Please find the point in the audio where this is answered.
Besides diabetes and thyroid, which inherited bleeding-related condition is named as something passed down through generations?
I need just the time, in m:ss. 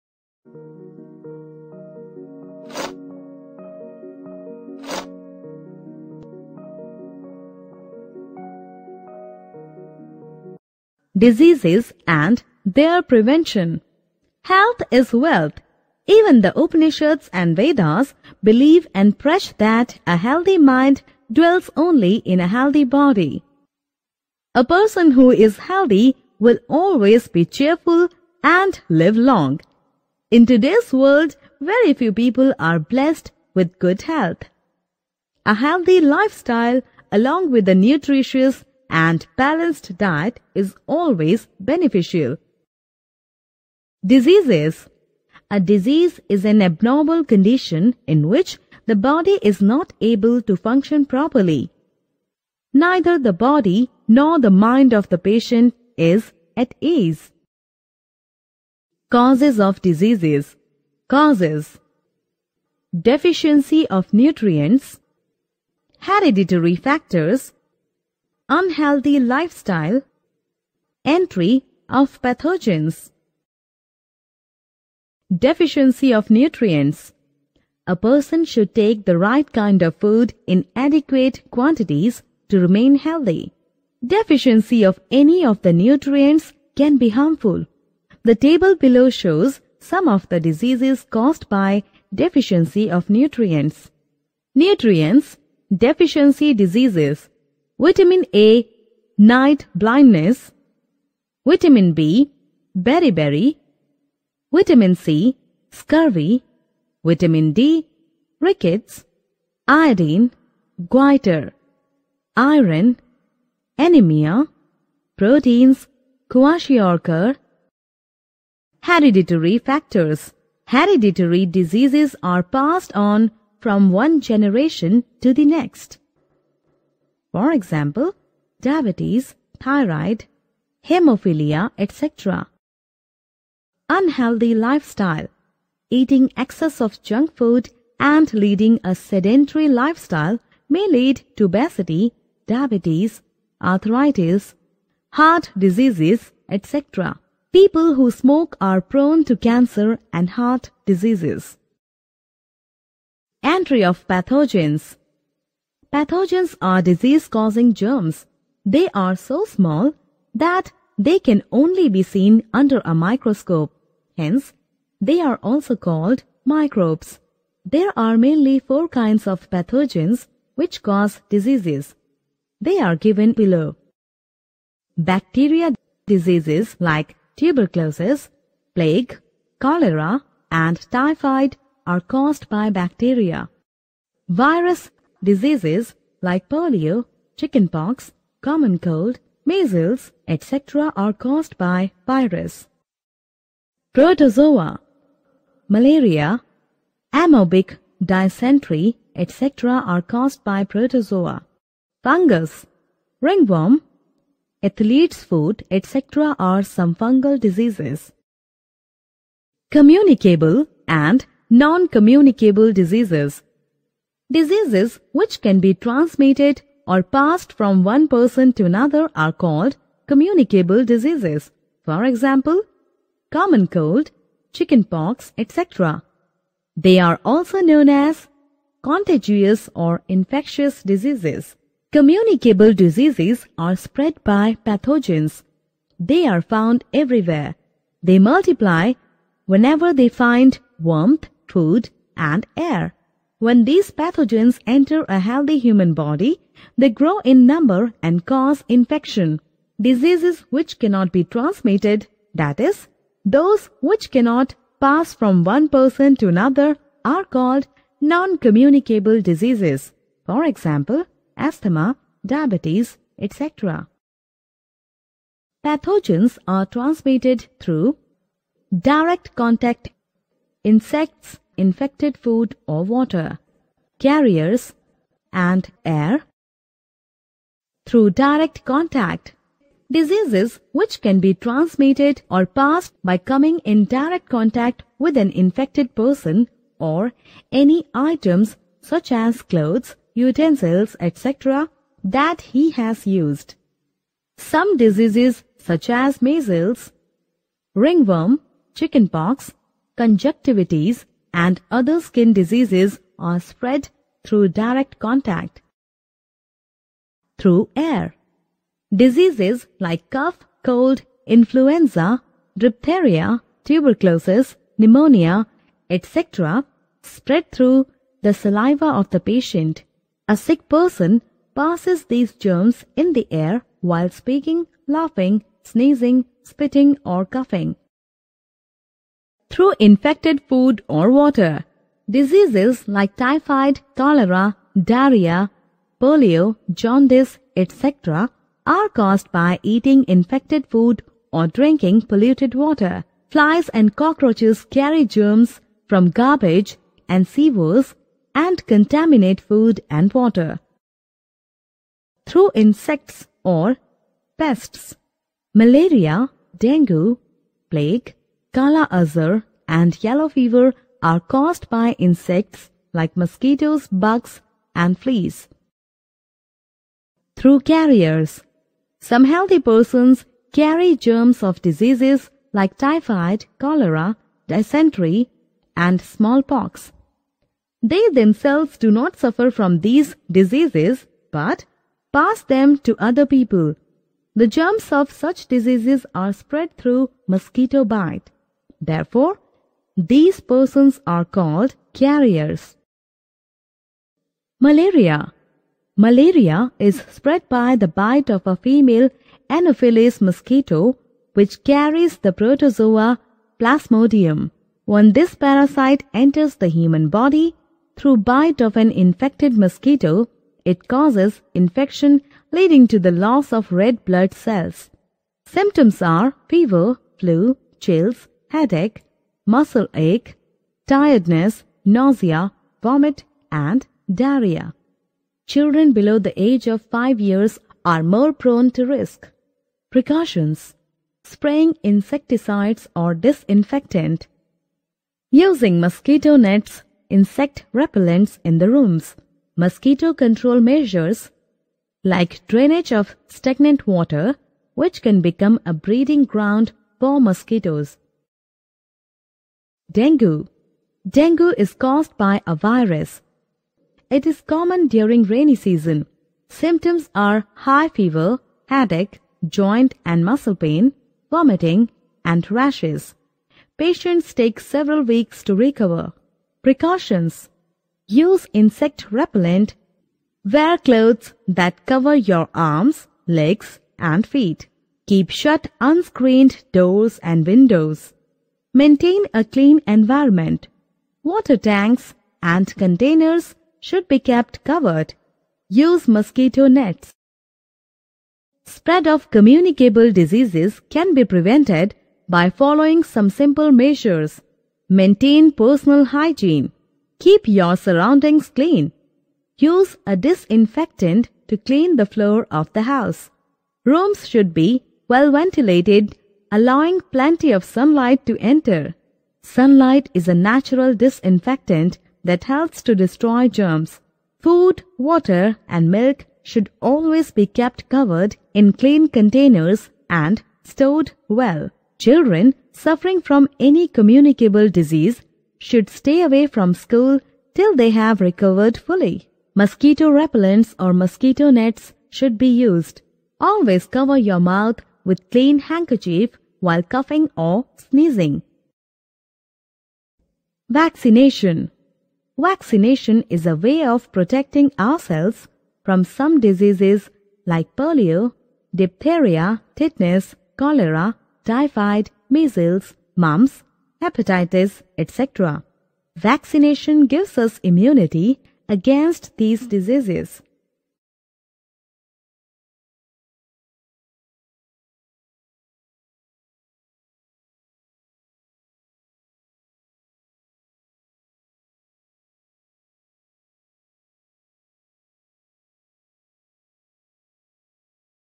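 2:10.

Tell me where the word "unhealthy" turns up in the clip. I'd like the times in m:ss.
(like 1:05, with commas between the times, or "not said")
1:08, 2:13.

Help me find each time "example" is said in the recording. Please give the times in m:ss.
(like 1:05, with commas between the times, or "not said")
2:07, 3:42, 4:20.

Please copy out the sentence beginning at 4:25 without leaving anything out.
Pathogens are transmitted through direct contact, insects, infected food or water, carriers, and air.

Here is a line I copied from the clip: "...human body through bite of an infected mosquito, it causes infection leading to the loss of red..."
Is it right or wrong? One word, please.
right.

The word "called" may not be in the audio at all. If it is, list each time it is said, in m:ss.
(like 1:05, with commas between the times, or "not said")
2:45, 3:39, 4:17, 6:31.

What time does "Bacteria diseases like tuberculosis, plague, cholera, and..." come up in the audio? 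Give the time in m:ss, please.
2:54.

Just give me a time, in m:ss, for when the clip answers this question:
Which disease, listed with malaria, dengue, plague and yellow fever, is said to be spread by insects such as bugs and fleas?
5:58.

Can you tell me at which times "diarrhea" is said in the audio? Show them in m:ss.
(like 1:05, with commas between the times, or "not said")
5:34, 7:04.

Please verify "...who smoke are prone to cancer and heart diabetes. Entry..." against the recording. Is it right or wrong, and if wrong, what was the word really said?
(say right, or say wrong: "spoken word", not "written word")
wrong: "diseases", not "diabetes".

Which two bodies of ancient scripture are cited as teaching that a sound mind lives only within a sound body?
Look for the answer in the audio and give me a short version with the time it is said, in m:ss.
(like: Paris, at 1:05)
Upanishads and Vedas, at 0:16.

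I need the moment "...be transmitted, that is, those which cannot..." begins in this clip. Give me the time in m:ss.
4:11.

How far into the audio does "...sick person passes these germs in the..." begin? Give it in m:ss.
5:20.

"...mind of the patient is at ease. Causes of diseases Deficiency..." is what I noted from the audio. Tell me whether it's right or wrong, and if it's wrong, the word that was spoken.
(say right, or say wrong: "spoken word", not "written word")
wrong: "Causes", not "Deficiency".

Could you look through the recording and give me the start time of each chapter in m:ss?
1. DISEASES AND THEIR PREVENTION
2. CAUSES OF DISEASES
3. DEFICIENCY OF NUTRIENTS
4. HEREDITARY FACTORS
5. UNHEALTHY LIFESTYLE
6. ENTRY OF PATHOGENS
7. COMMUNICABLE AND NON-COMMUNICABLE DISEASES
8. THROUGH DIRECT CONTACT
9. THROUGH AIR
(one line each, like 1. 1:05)
1. 0:11
2. 0:59
3. 1:15
4. 1:59
5. 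2:14
6. 2:33
7. 3:30
8. 4:38
9. 5:07.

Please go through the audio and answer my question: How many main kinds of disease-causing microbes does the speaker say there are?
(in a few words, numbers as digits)
4.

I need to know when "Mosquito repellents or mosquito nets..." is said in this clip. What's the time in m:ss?
8:49.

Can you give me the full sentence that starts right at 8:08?
Spread of communicable diseases can be prevented by following some simple measures.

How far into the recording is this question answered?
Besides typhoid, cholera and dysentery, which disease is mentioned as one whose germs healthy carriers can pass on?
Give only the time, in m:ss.
6:16.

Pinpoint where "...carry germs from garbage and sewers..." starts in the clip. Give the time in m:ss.
5:44.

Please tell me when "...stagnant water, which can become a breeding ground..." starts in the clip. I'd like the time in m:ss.
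7:23.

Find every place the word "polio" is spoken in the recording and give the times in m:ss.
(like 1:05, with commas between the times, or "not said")
3:06, 5:36, 9:07.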